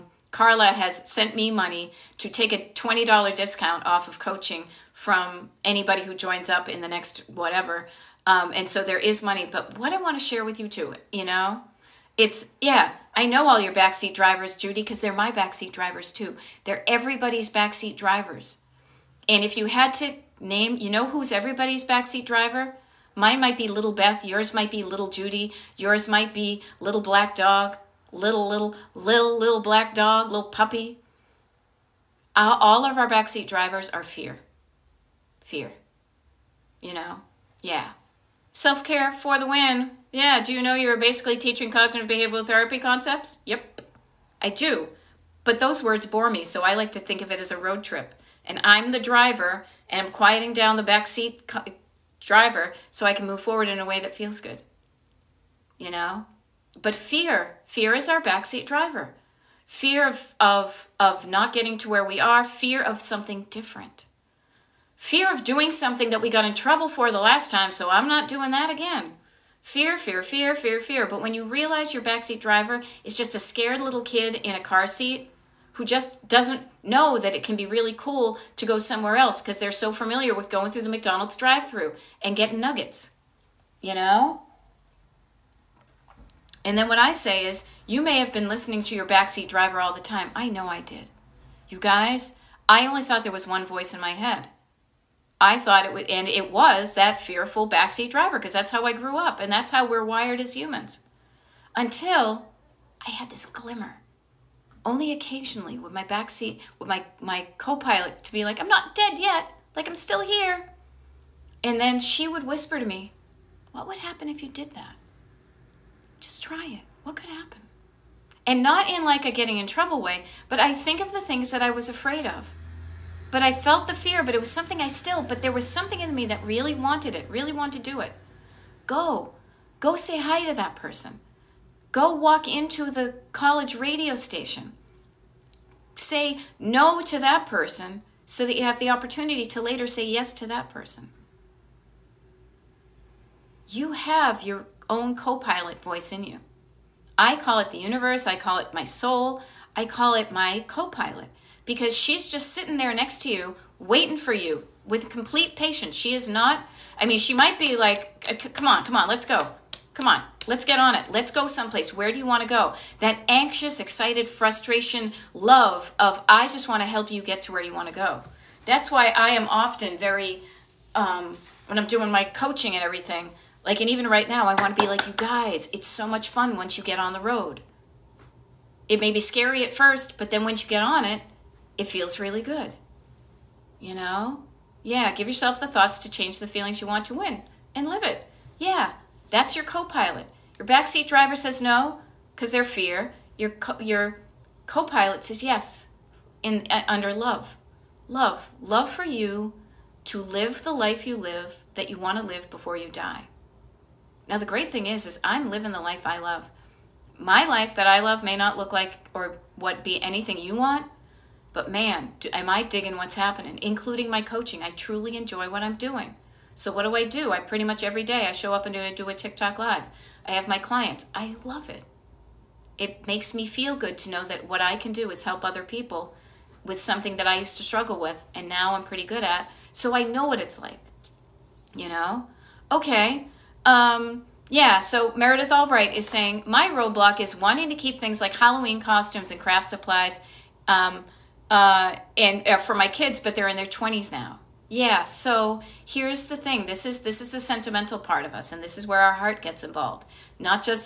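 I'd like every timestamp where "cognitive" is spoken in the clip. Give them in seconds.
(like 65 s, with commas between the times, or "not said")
41 s.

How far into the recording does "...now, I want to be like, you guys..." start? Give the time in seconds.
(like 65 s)
174 s.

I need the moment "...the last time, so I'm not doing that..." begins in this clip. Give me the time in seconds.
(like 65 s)
67 s.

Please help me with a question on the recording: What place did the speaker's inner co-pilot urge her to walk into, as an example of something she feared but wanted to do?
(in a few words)
college radio station.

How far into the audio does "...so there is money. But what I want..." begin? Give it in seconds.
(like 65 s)
8 s.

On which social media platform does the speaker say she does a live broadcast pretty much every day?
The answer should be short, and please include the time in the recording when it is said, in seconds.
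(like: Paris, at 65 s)
TikTok, at 219 s.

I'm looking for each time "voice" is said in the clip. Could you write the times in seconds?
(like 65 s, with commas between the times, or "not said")
93 s, 145 s.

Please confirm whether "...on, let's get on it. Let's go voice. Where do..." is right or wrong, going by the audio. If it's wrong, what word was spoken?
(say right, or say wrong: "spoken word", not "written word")
wrong: "someplace", not "voice".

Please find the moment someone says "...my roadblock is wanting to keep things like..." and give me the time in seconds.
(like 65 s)
236 s.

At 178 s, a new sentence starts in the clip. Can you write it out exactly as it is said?
It may be scary at first, but then once you get on it, it feels really good.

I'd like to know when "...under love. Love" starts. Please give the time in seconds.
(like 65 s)
196 s.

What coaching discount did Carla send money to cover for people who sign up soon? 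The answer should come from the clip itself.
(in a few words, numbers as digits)
$20.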